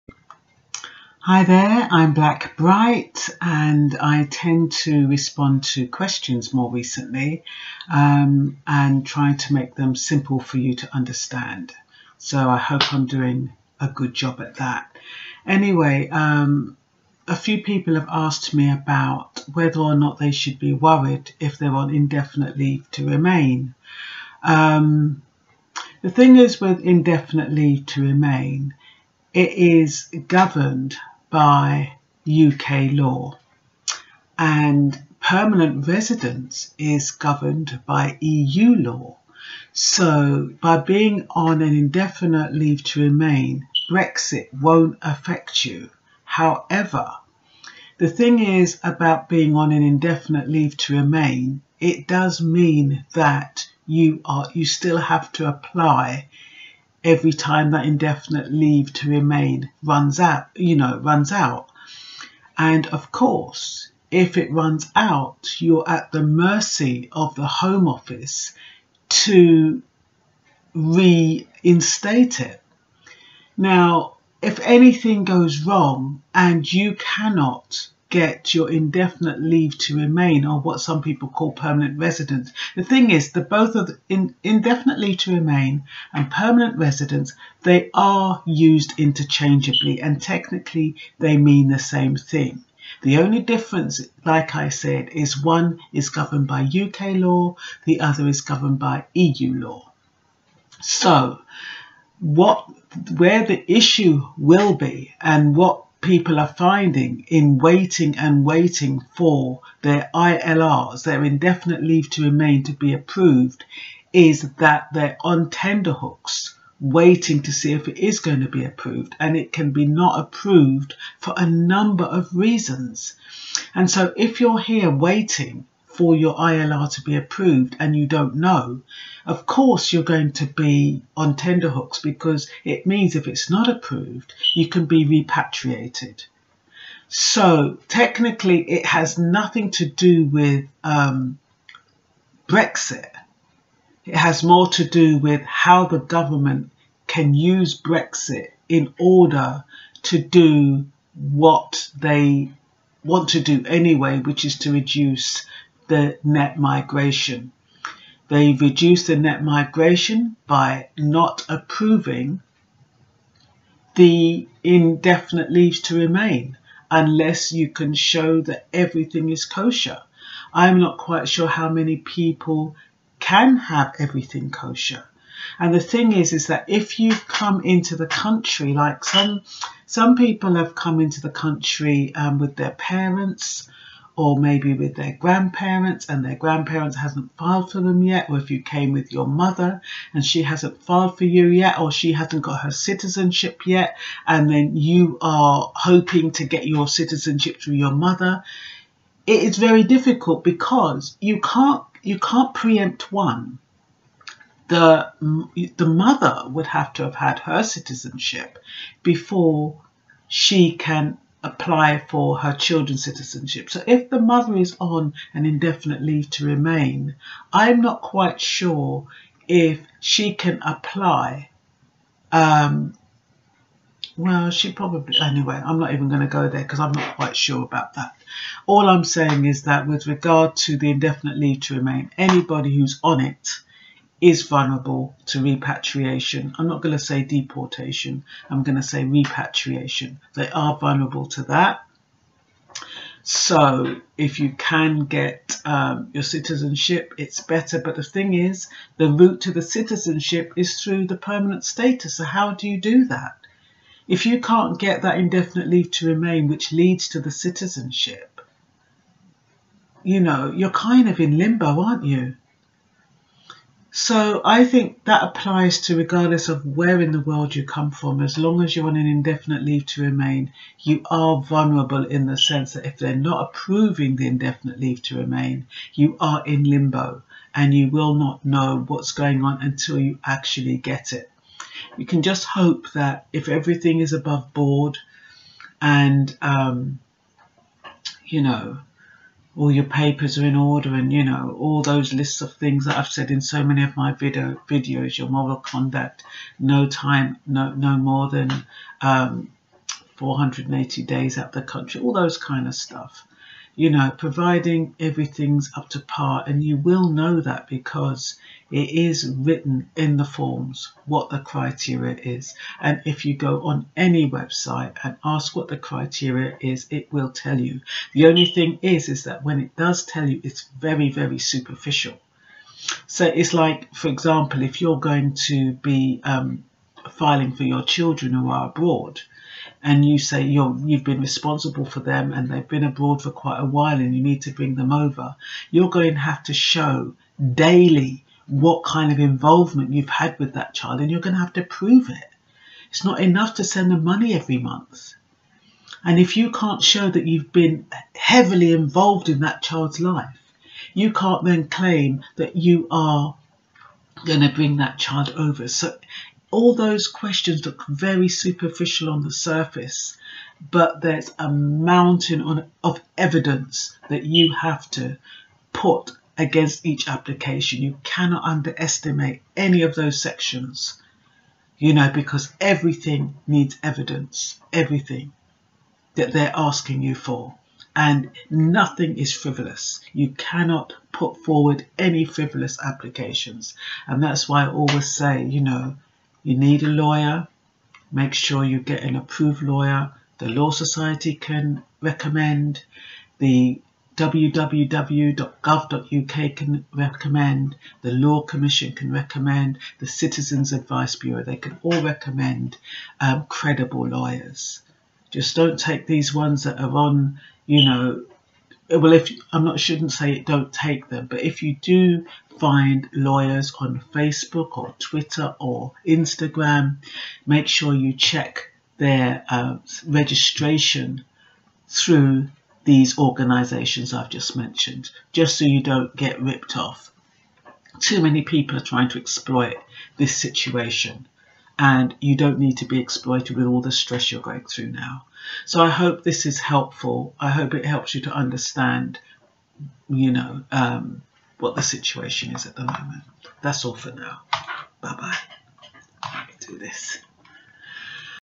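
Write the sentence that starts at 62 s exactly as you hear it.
And of course, if it runs out, you're at the mercy of the Home Office to reinstate it.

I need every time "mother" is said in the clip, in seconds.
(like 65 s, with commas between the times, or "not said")
189 s, 197 s, 205 s, 214 s.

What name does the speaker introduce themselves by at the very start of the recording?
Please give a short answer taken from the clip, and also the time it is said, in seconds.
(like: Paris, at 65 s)
Blackbright, at 2 s.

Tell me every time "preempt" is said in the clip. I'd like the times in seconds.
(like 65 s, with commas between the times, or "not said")
202 s.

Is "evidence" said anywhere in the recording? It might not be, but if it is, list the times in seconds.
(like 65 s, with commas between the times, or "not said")
363 s, 373 s.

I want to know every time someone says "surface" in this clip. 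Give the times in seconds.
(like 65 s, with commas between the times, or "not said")
359 s.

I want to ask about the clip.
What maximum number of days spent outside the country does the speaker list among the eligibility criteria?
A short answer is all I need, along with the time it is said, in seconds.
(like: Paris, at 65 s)
480, at 300 s.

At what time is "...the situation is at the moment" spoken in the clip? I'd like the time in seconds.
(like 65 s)
441 s.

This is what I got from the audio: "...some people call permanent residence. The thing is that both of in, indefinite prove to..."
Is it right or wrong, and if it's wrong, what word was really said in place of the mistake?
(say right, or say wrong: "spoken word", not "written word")
wrong: "leave", not "prove".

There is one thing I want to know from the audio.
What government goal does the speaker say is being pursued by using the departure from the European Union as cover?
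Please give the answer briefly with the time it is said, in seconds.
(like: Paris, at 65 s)
reduce the net migration, at 154 s.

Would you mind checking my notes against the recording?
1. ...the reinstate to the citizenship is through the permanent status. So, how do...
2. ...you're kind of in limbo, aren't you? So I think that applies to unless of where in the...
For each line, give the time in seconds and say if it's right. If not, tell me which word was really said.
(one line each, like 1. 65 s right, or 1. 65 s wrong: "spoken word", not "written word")
1. 248 s wrong: "route", not "reinstate"
2. 260 s wrong: "regardless", not "unless".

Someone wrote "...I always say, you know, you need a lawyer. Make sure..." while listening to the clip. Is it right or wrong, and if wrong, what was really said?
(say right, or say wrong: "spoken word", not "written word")
right.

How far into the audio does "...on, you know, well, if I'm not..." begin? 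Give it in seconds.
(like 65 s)
406 s.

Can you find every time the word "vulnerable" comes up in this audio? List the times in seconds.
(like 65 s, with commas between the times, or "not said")
234 s, 240 s, 271 s.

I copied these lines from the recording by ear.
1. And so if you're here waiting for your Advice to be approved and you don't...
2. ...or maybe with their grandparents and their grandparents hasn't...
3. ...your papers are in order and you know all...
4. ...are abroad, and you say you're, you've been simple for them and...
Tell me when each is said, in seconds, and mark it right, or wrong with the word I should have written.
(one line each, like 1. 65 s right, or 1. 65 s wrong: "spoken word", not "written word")
1. 123 s wrong: "ILR", not "Advice"
2. 184 s right
3. 289 s right
4. 328 s wrong: "responsible", not "simple".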